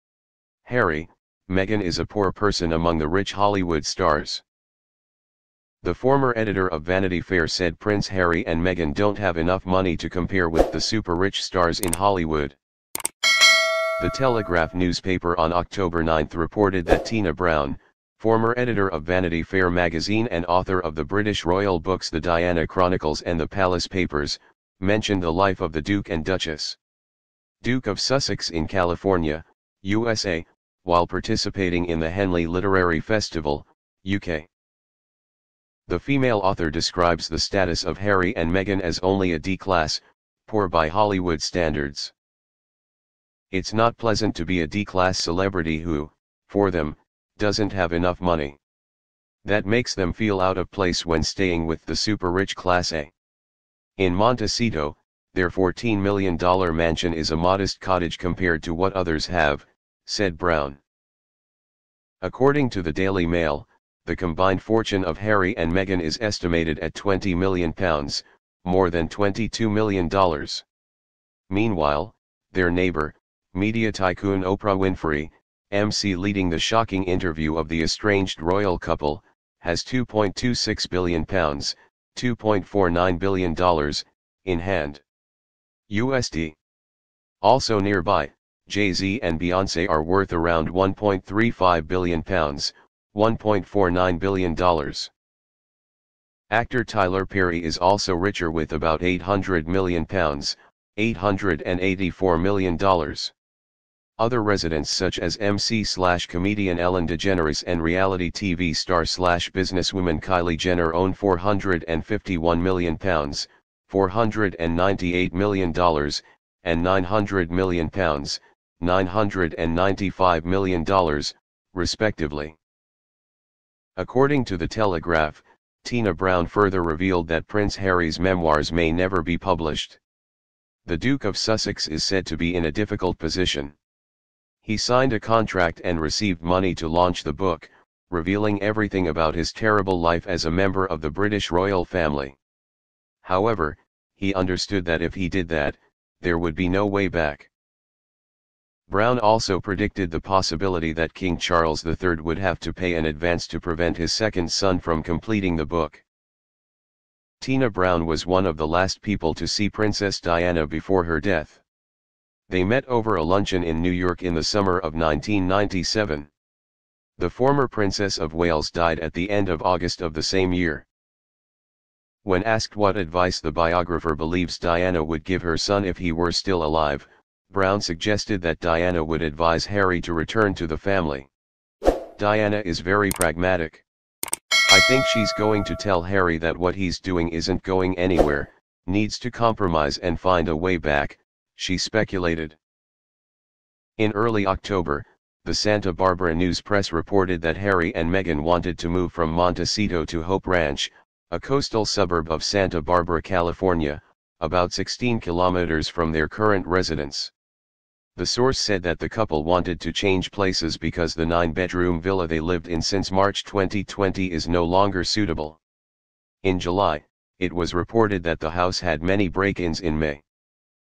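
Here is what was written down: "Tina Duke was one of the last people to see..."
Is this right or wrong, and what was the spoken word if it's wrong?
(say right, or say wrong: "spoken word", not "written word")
wrong: "Brown", not "Duke".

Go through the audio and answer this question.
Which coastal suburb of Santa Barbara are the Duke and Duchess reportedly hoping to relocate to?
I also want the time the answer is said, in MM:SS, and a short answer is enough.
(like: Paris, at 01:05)
Hope Ranch, at 03:20.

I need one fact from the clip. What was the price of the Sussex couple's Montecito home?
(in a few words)
$14 million.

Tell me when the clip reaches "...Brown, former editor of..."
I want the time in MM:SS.
00:17.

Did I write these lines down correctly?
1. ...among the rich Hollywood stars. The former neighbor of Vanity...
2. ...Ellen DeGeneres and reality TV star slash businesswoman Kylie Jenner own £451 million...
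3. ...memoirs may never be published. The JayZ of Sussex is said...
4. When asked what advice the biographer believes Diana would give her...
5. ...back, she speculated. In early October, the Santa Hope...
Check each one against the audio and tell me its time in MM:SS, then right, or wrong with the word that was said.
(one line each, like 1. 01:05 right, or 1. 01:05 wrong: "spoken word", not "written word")
1. 00:02 wrong: "editor", not "neighbor"
2. 01:46 right
3. 02:08 wrong: "Duke", not "JayZ"
4. 02:52 right
5. 03:10 wrong: "Barbara", not "Hope".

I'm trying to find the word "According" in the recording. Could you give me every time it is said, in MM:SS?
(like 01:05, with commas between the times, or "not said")
01:02, 02:03.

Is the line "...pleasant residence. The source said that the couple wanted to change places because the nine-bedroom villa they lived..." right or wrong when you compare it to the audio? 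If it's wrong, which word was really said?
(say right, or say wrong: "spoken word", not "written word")
wrong: "current", not "pleasant".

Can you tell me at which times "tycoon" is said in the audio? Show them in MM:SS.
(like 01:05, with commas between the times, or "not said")
01:13.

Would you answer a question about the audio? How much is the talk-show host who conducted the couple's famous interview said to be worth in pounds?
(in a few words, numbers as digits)
£2.26 billion.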